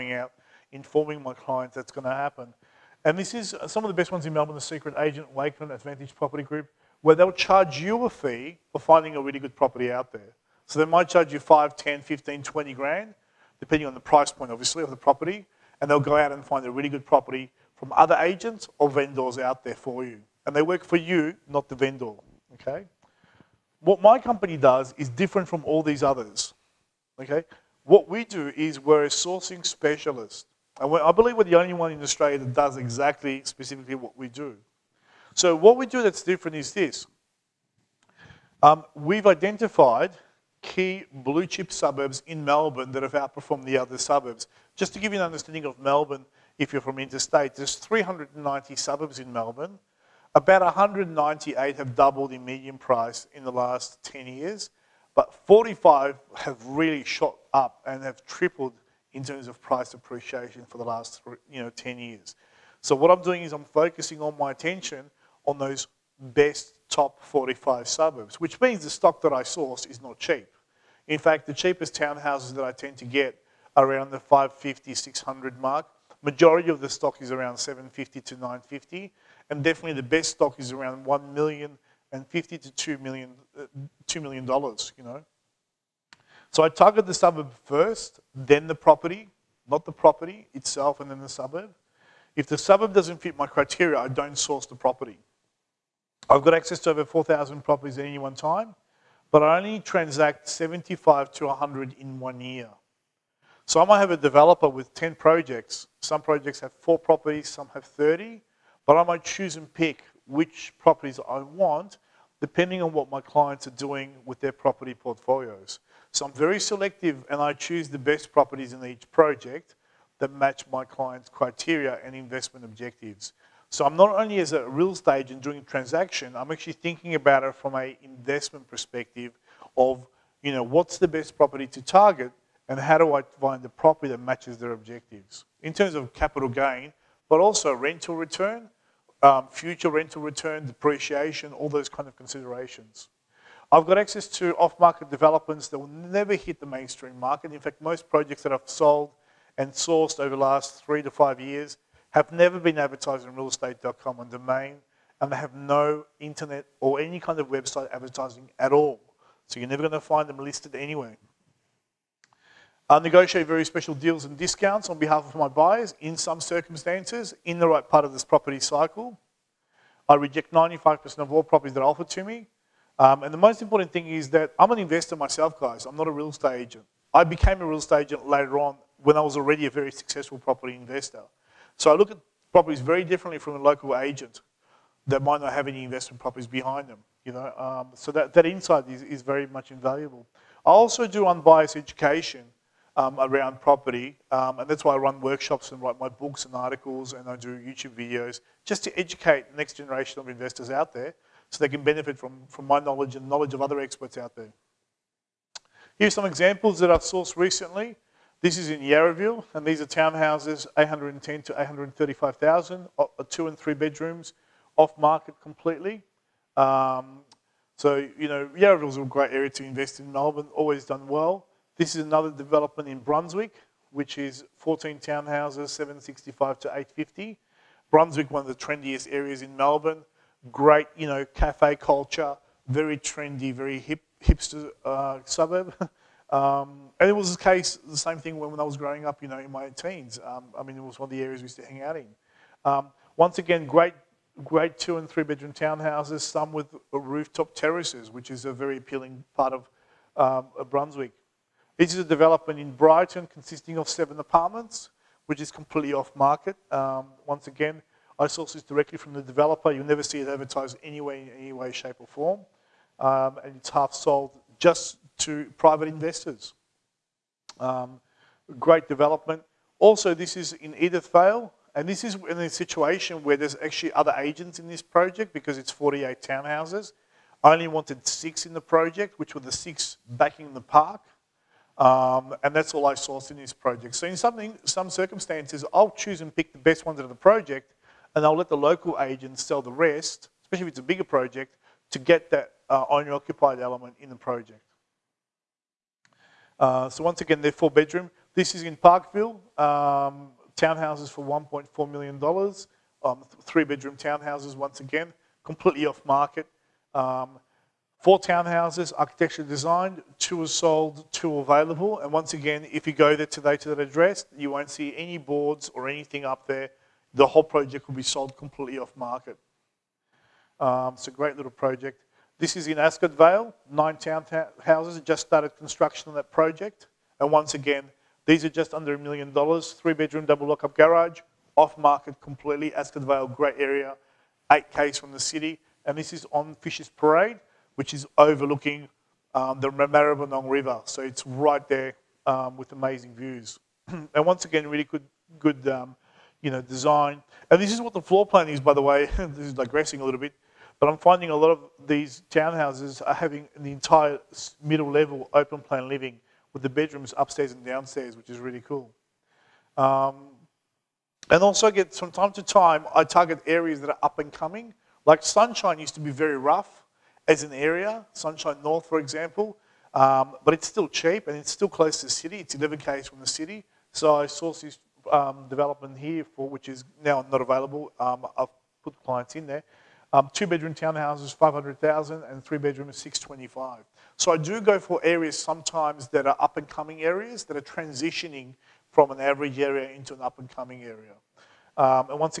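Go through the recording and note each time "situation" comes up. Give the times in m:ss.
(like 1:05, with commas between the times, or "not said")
4:32.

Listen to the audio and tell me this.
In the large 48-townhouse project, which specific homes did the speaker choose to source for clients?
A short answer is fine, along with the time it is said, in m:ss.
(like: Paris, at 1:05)
the six backing the park, at 4:39.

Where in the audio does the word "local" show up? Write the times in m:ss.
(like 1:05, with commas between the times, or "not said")
3:03, 4:48.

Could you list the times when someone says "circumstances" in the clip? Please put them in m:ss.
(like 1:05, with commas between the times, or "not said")
2:46, 4:44.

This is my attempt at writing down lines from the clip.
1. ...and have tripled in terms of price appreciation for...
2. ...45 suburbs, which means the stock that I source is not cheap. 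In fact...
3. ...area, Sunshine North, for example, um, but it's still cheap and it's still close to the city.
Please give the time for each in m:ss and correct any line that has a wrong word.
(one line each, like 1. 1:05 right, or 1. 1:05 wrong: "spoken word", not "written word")
1. 0:57 right
2. 1:07 right
3. 6:07 right.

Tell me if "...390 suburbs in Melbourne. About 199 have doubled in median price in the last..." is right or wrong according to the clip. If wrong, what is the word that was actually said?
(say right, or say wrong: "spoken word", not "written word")
wrong: "198", not "199".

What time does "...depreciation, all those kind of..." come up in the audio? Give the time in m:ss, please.
2:20.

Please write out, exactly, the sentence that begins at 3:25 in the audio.
Here's some examples that I've sourced recently.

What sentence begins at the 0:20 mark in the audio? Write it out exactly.
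And they work for you, not the vendor, okay?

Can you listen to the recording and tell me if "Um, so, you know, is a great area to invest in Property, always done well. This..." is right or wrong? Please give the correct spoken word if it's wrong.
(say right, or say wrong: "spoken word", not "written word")
wrong: "Melbourne", not "Property".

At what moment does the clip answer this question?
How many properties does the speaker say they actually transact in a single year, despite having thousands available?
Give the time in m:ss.
1:40.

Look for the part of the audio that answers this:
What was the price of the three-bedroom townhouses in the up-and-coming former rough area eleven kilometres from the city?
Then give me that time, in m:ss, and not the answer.
6:22.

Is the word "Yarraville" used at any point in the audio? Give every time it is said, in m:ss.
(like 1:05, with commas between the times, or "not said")
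3:28.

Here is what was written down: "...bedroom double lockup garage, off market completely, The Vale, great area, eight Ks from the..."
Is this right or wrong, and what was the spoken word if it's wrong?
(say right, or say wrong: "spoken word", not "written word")
wrong: "Ascot", not "The".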